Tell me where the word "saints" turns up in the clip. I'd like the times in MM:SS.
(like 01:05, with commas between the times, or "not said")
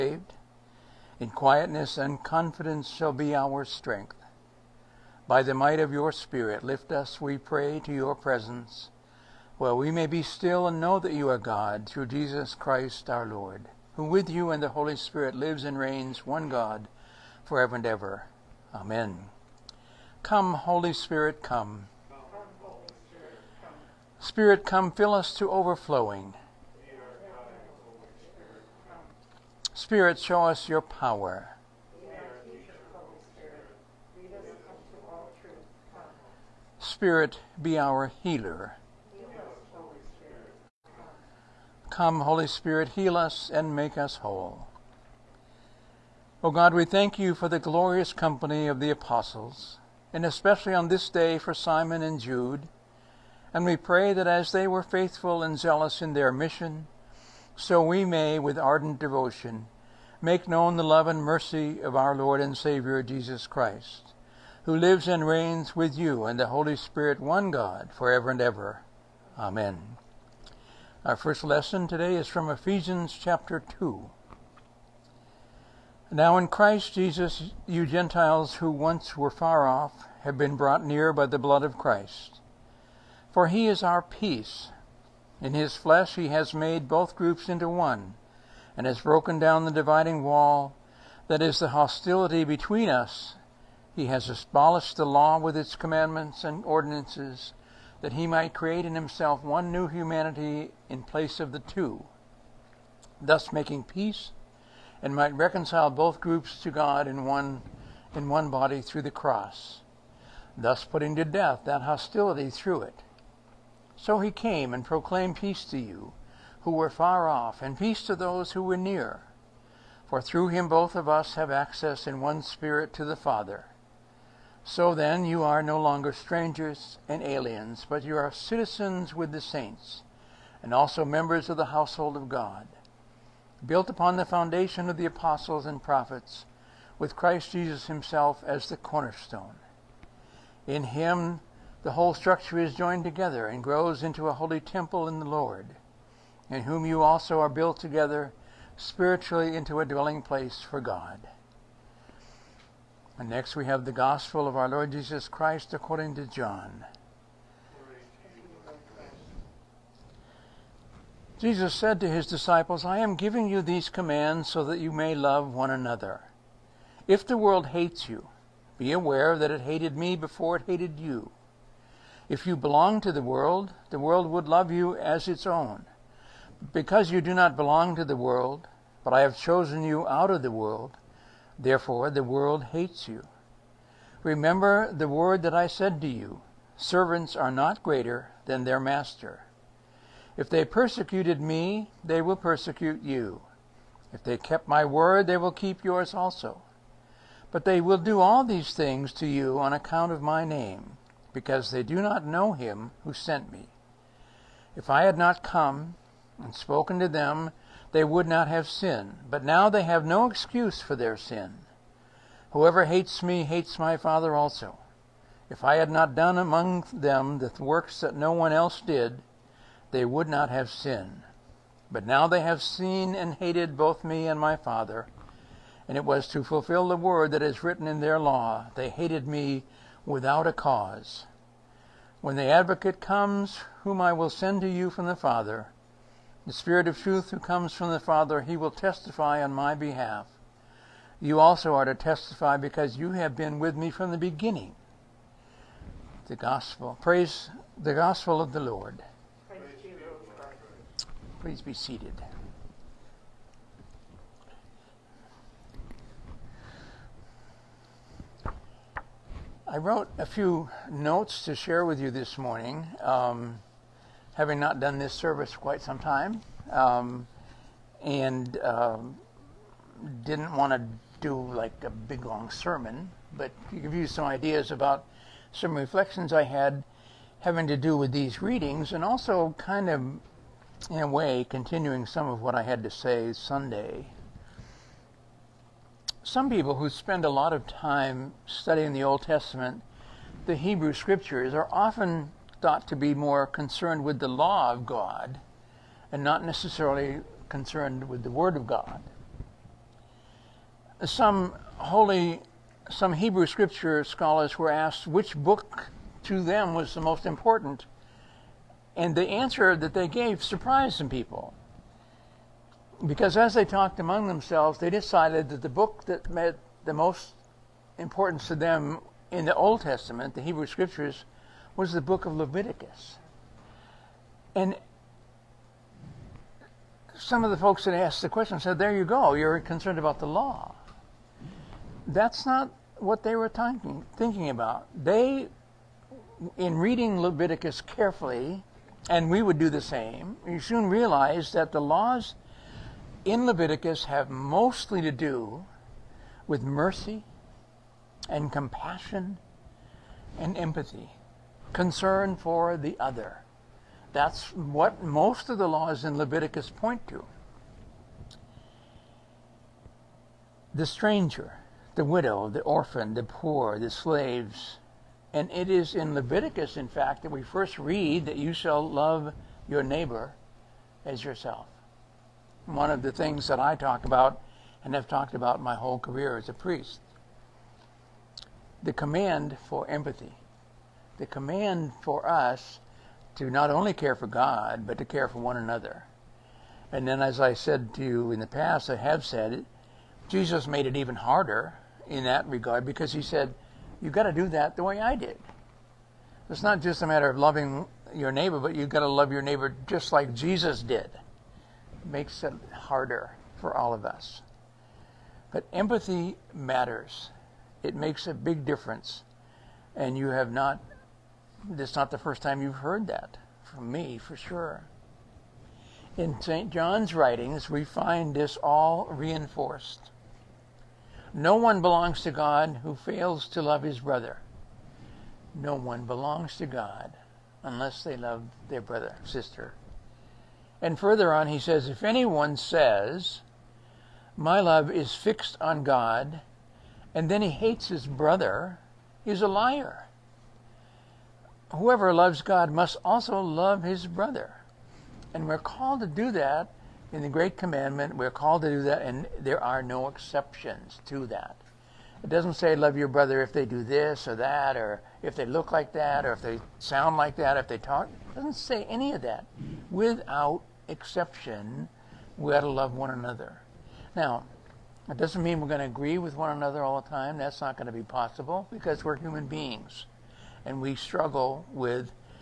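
02:09.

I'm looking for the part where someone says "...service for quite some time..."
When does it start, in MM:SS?
04:25.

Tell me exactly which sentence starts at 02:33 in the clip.
And next we have the gospel of our Lord Jesus Christ according to John.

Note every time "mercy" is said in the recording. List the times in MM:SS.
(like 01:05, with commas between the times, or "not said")
01:01, 05:46.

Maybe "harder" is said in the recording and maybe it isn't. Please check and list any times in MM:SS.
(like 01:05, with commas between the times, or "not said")
06:31, 06:42.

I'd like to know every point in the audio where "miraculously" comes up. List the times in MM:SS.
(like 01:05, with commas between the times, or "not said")
not said.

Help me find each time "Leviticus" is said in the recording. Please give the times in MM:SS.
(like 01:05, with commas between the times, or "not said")
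05:22, 05:37, 05:43, 05:56, 06:06.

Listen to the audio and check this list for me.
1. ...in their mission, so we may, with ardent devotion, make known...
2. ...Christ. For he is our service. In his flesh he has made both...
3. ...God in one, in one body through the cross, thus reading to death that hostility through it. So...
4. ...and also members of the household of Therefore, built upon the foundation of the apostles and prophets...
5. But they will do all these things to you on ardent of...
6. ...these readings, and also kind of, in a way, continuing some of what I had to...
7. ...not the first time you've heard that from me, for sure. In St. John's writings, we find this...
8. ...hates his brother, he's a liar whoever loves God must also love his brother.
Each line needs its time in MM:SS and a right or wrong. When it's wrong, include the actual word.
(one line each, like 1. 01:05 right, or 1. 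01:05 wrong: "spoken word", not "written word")
1. 00:56 right
2. 01:21 wrong: "peace", not "service"
3. 01:46 wrong: "putting", not "reading"
4. 02:10 wrong: "God", not "Therefore"
5. 03:17 wrong: "account", not "ardent"
6. 04:38 right
7. 06:51 right
8. 07:17 right.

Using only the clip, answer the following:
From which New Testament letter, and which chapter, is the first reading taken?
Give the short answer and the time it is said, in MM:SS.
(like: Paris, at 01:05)
Ephesians 2, at 01:12.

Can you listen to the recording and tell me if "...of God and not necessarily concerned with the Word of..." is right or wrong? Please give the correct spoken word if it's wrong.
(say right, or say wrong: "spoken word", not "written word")
right.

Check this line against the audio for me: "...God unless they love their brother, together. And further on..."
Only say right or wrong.
wrong.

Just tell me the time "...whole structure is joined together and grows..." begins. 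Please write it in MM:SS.
02:21.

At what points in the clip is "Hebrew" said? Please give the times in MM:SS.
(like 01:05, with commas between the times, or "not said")
04:50, 05:03, 05:20.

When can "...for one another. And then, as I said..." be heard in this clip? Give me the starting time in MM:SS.
06:25.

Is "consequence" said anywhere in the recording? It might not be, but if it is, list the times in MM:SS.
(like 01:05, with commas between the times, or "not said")
not said.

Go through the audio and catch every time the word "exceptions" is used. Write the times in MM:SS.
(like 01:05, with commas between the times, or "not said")
07:30, 07:40.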